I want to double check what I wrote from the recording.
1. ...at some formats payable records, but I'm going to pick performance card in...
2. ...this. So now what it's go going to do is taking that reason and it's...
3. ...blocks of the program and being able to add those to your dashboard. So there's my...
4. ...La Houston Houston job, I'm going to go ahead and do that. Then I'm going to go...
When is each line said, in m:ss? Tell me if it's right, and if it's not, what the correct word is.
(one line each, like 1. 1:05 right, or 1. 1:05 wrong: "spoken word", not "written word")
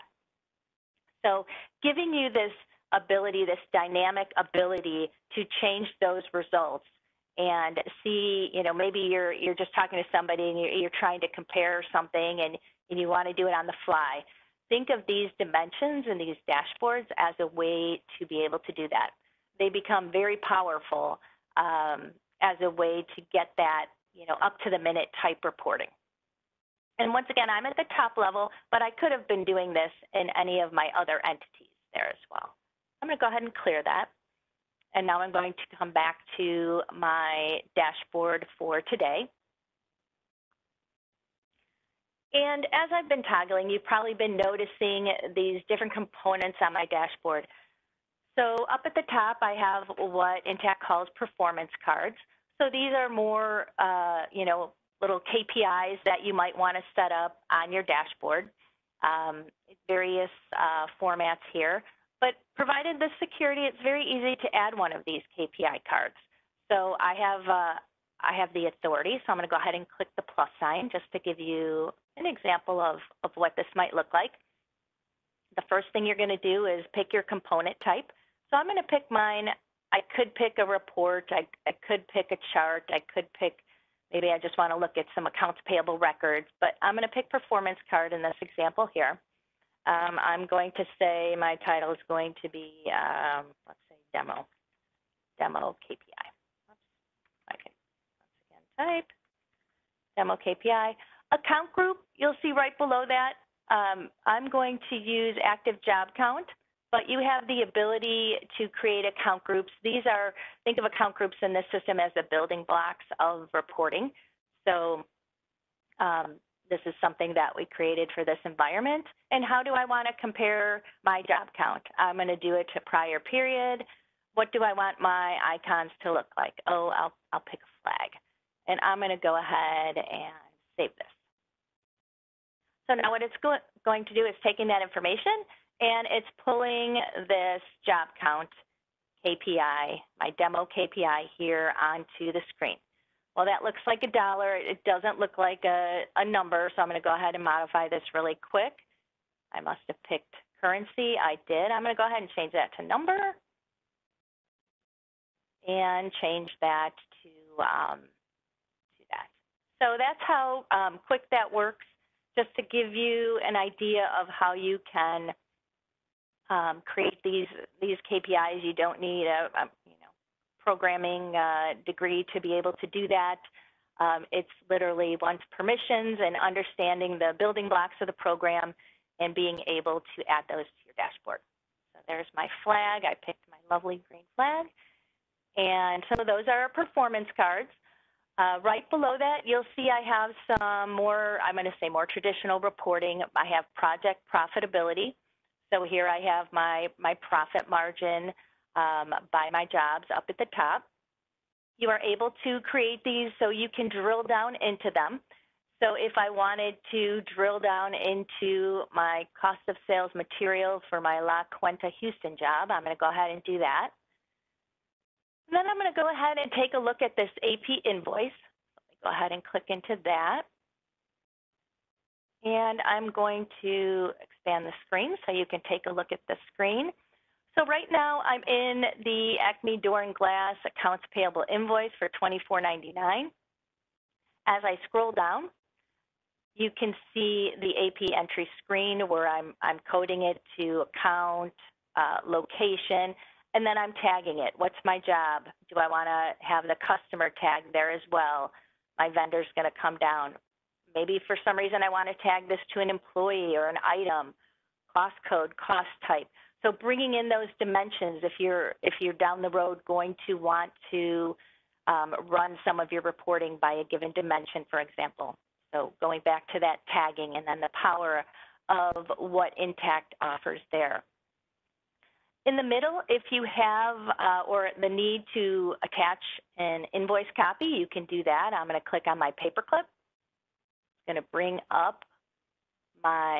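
1. 1:24 wrong: "accounts", not "formats"
2. 2:10 wrong: "information", not "reason"
3. 2:57 right
4. 3:31 wrong: "Cuenta", not "Houston".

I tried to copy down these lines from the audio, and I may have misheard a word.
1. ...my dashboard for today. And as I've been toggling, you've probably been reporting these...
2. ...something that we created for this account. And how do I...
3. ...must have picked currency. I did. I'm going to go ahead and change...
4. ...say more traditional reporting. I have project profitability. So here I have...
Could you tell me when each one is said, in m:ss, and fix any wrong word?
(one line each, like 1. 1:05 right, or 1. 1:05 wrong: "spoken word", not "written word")
1. 0:36 wrong: "noticing", not "reporting"
2. 1:56 wrong: "environment", not "account"
3. 2:29 right
4. 3:11 right.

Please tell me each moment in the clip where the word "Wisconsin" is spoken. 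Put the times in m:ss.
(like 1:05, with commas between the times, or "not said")
not said.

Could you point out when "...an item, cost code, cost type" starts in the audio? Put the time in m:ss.
4:13.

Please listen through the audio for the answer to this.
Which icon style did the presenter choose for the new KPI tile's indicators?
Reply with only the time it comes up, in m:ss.
2:07.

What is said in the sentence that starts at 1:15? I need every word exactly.
The first thing you're going to do is pick your component type.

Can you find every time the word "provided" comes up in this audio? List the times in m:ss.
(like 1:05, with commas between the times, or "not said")
1:02.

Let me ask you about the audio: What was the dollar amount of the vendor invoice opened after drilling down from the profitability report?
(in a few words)
$24.99.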